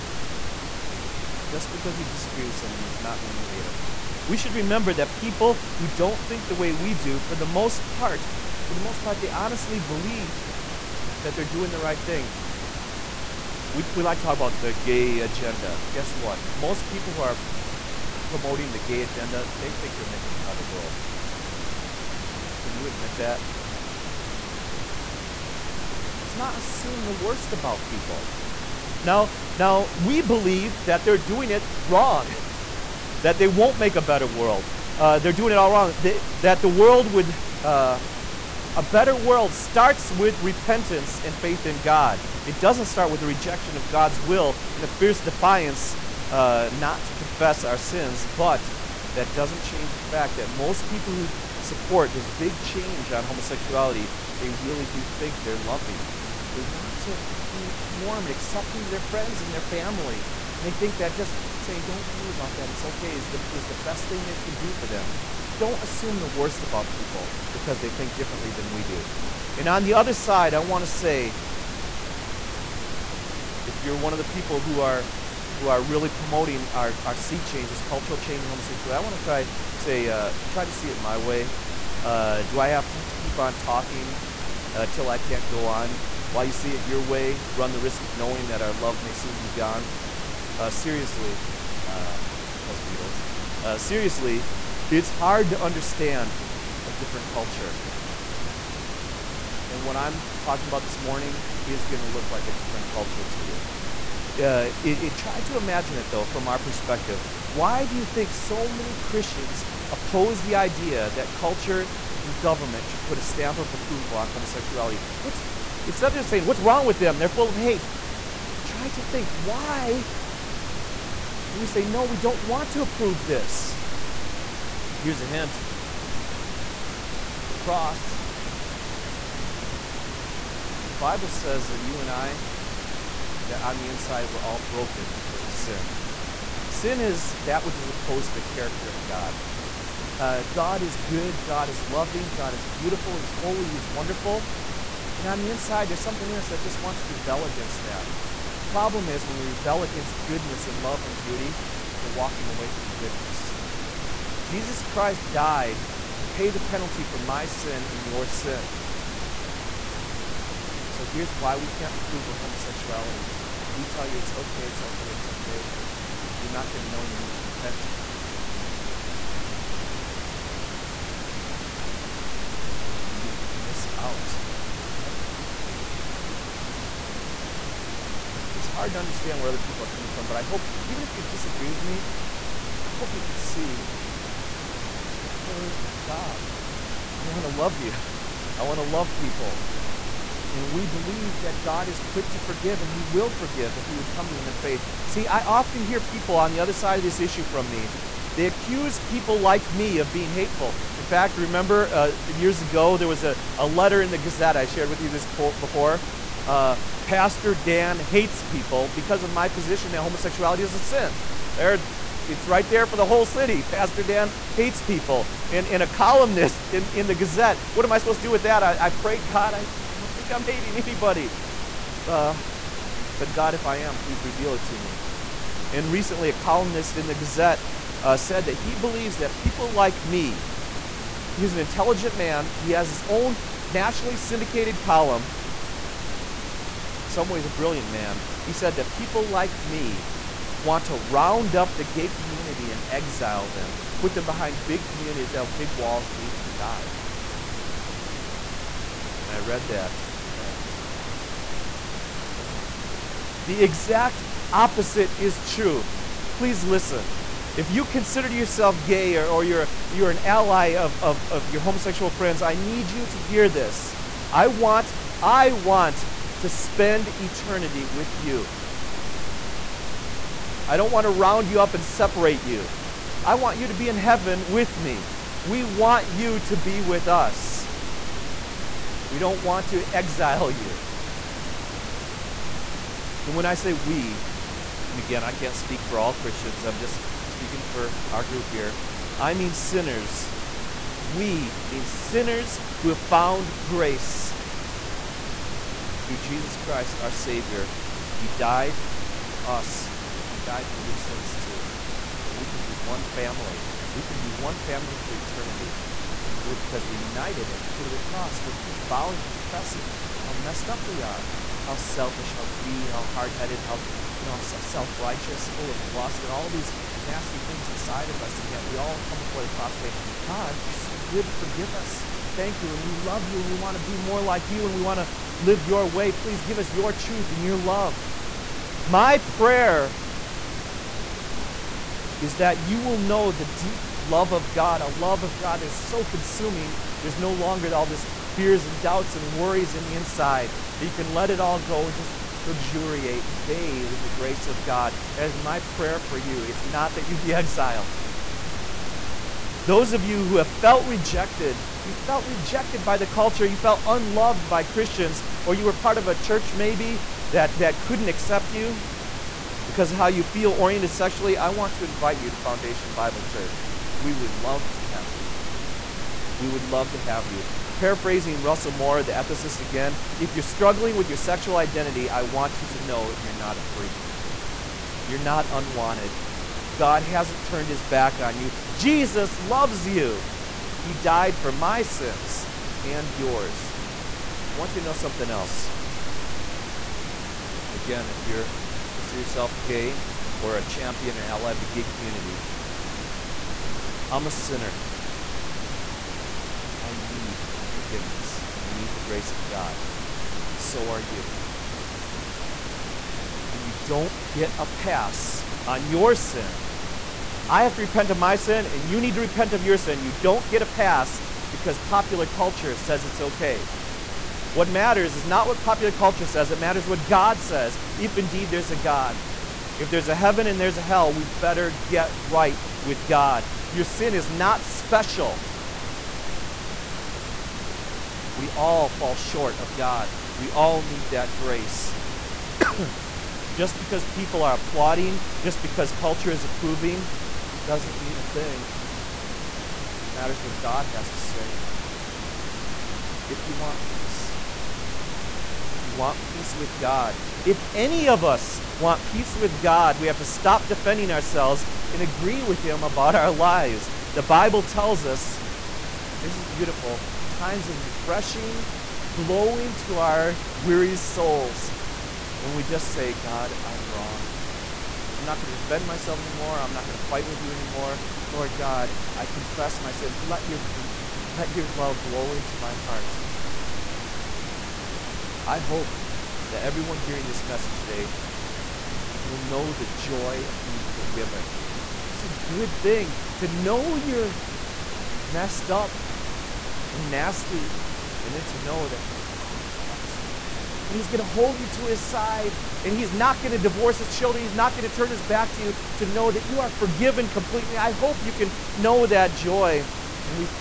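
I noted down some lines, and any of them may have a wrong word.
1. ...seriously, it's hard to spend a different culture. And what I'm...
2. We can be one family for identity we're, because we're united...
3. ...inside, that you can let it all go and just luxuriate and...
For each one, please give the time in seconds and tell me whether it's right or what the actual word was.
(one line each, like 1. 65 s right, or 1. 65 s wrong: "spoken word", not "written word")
1. 93 s wrong: "understand", not "spend"
2. 303 s wrong: "eternity", not "identity"
3. 339 s right.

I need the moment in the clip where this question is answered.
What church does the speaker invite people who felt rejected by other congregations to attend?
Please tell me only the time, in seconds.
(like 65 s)
362 s.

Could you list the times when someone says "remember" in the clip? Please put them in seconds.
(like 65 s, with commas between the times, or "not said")
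4 s, 201 s.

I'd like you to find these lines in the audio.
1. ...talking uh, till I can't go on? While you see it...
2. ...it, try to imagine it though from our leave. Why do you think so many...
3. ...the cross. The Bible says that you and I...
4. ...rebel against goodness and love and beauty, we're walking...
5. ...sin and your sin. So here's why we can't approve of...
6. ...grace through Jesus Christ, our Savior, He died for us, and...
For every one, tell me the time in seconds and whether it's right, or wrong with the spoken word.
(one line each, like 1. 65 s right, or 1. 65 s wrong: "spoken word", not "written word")
1. 83 s right
2. 104 s wrong: "perspective", not "leave"
3. 127 s right
4. 149 s right
5. 157 s right
6. 293 s right.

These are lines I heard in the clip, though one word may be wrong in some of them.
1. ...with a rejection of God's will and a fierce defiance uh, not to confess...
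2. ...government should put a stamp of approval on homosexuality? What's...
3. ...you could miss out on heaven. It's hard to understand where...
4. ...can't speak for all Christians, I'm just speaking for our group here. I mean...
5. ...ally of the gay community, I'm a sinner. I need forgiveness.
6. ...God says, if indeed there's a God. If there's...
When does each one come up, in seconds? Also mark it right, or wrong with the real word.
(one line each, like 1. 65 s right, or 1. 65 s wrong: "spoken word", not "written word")
1. 43 s right
2. 112 s right
3. 173 s right
4. 285 s right
5. 391 s right
6. 417 s right.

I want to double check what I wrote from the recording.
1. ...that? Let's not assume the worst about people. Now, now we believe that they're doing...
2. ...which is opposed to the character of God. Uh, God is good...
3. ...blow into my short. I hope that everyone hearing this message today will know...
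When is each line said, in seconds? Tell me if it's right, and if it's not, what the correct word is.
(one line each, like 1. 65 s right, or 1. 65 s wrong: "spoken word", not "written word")
1. 23 s right
2. 137 s right
3. 472 s wrong: "heart", not "short".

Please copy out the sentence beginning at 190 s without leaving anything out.
And we believe that God is quick to forgive and He will forgive if we would come to Him in faith.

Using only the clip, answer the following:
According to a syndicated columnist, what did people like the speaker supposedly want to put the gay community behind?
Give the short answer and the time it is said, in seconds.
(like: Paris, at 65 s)
Big walls, at 245 s.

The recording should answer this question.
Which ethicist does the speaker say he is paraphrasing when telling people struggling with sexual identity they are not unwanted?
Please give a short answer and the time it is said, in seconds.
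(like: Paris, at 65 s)
Russell Moore, at 368 s.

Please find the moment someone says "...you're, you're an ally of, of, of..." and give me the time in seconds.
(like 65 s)
259 s.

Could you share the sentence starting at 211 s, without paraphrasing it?
There, it's right there for the whole city.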